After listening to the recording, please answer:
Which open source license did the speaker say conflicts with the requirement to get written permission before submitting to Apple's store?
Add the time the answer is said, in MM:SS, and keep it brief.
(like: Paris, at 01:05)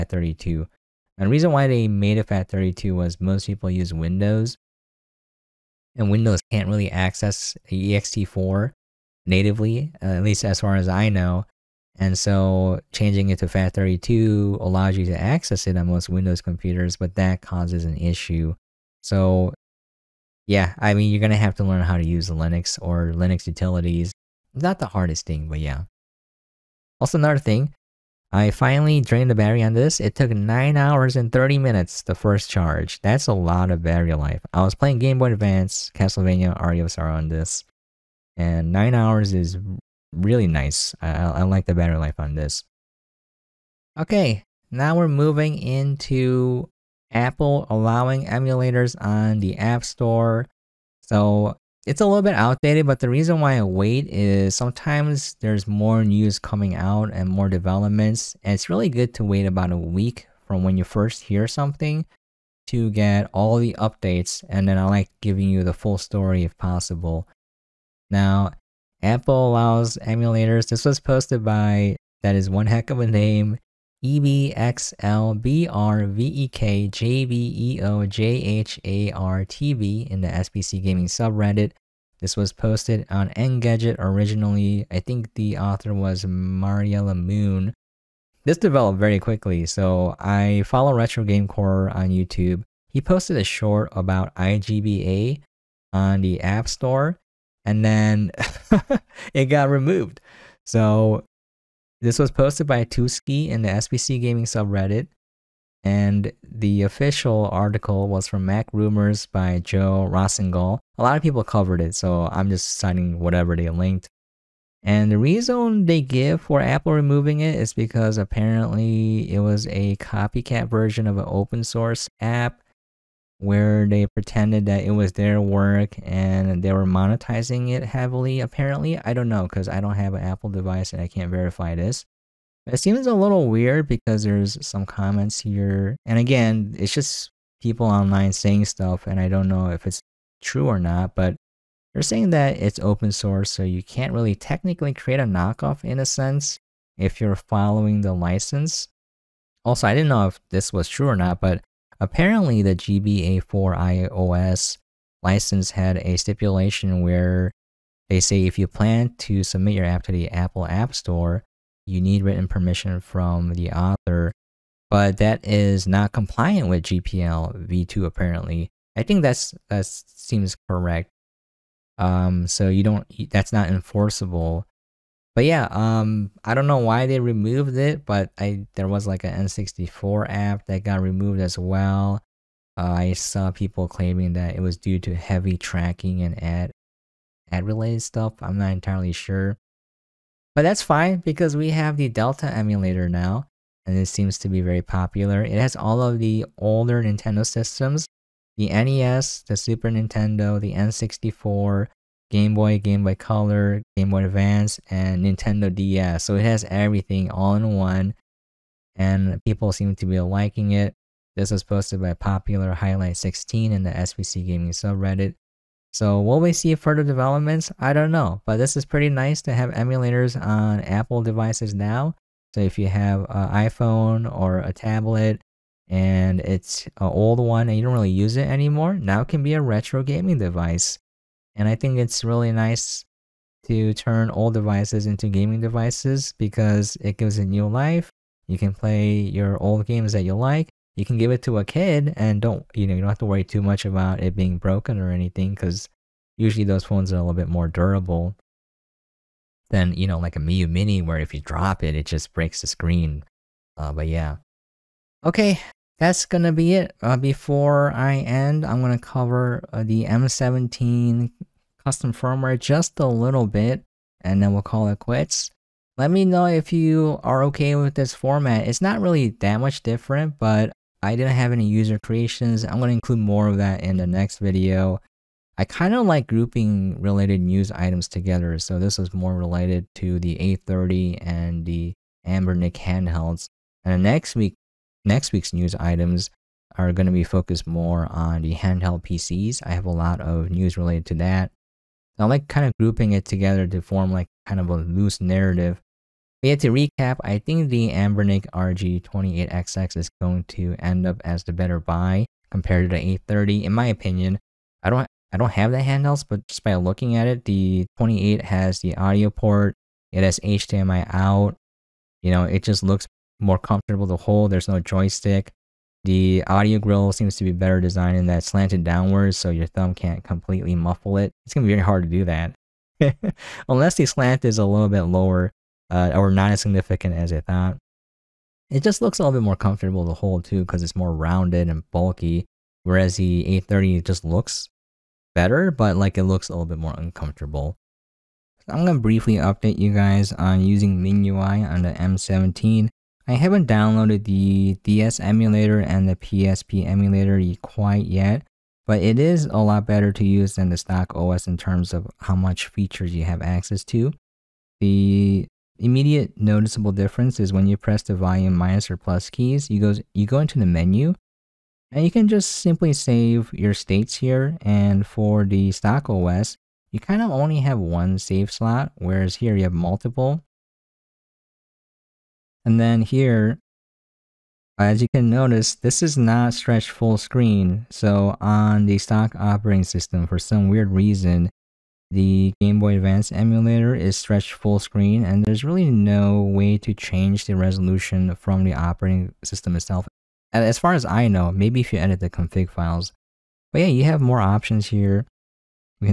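GPL v2, at 02:46.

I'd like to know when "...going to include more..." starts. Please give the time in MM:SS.
04:32.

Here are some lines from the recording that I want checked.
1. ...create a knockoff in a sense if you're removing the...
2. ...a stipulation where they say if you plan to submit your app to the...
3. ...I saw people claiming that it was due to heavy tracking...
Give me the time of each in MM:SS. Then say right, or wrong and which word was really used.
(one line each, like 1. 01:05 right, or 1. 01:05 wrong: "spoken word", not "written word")
1. 02:24 wrong: "following", not "removing"
2. 02:35 right
3. 03:02 right.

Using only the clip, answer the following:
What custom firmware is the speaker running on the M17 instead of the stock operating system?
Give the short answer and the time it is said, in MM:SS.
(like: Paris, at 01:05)
MinUI, at 05:41.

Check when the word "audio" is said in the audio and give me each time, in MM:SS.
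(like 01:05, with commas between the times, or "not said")
05:08, 05:16.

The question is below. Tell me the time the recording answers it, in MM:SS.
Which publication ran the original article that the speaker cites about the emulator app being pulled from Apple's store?
01:48.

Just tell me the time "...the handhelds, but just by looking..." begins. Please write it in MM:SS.
05:05.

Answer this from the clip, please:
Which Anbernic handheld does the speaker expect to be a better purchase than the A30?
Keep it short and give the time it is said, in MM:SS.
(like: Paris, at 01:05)
Anbernic RG28XX, at 04:57.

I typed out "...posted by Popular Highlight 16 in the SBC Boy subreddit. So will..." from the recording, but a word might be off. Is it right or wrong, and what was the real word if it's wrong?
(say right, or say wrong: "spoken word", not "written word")
wrong: "Gaming", not "Boy".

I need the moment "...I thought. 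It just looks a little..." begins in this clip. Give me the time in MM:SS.
05:27.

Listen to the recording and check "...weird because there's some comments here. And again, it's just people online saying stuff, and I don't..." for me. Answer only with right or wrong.
right.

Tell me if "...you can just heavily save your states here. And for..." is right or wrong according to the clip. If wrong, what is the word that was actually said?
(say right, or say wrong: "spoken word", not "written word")
wrong: "simply", not "heavily".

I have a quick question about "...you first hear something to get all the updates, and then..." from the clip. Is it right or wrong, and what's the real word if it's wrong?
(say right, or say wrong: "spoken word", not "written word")
right.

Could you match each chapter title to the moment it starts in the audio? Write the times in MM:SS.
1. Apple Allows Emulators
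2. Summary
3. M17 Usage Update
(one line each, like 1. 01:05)
1. 00:44
2. 04:14
3. 05:37.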